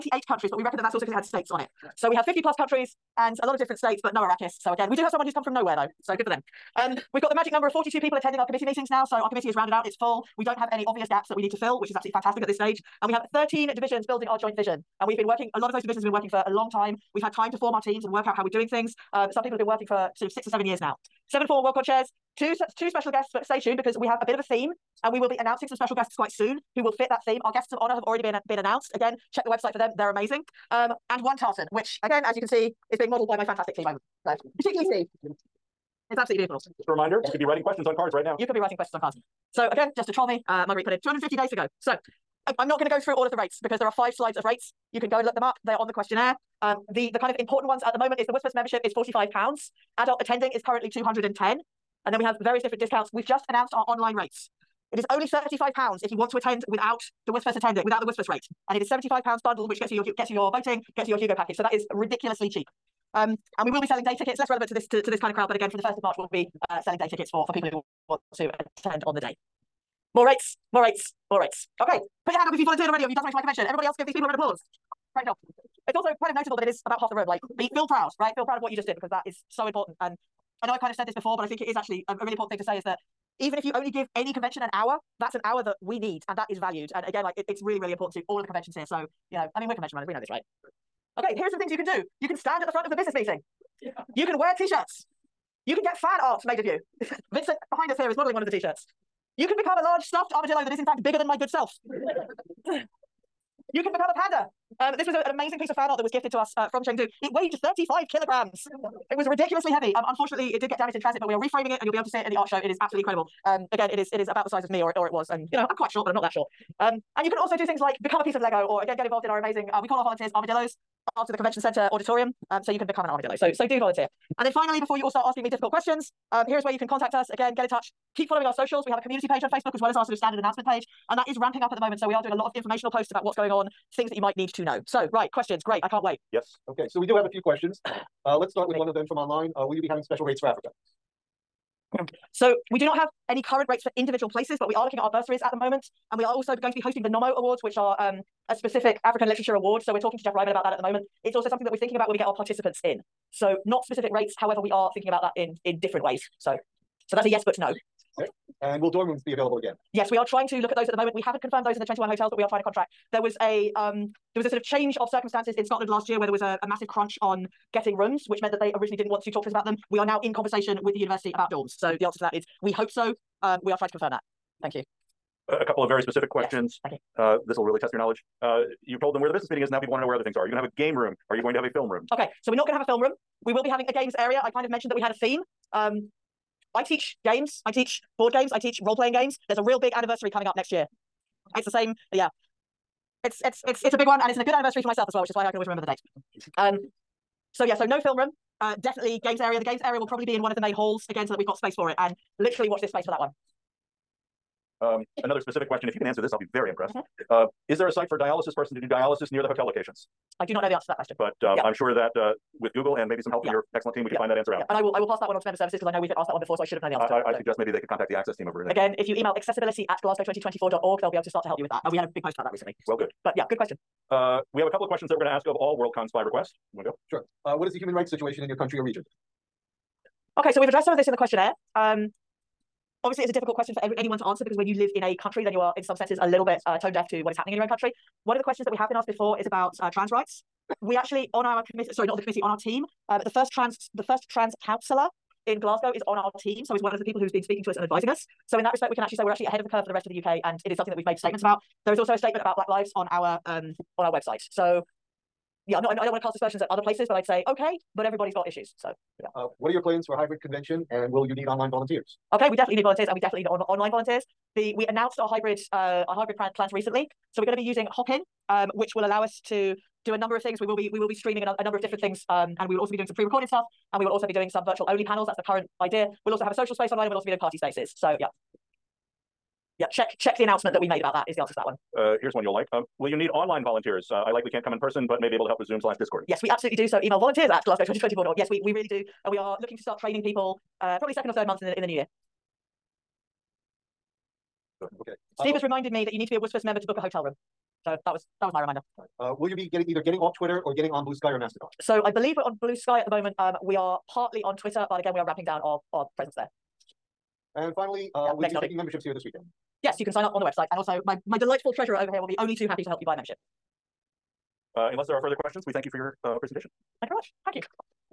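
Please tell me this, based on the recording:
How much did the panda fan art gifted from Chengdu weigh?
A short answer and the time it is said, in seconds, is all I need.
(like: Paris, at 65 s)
35 kilograms, at 107 s.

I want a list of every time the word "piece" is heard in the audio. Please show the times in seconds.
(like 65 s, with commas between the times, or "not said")
105 s, 118 s.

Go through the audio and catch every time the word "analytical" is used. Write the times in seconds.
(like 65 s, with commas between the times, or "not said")
not said.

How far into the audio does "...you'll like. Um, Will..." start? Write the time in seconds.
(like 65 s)
282 s.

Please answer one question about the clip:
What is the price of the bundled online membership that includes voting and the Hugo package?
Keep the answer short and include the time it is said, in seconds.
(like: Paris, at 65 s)
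£75, at 58 s.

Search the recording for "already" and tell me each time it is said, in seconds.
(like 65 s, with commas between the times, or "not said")
28 s, 72 s.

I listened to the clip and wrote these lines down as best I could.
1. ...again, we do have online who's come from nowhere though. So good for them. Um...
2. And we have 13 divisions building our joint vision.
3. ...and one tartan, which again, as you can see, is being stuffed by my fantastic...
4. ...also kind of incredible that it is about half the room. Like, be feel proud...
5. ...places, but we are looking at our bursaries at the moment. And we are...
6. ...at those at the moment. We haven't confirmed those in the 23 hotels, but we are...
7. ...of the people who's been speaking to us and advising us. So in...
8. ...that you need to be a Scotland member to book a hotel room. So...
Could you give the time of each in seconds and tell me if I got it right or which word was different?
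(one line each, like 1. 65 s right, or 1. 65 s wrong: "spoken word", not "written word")
1. 4 s wrong: "someone", not "online"
2. 13 s right
3. 31 s wrong: "modelled", not "stuffed"
4. 75 s wrong: "notable", not "incredible"
5. 144 s right
6. 160 s wrong: "21", not "23"
7. 246 s right
8. 296 s wrong: "WSFS", not "Scotland".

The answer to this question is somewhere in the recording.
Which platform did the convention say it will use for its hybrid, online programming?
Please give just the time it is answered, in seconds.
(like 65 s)
267 s.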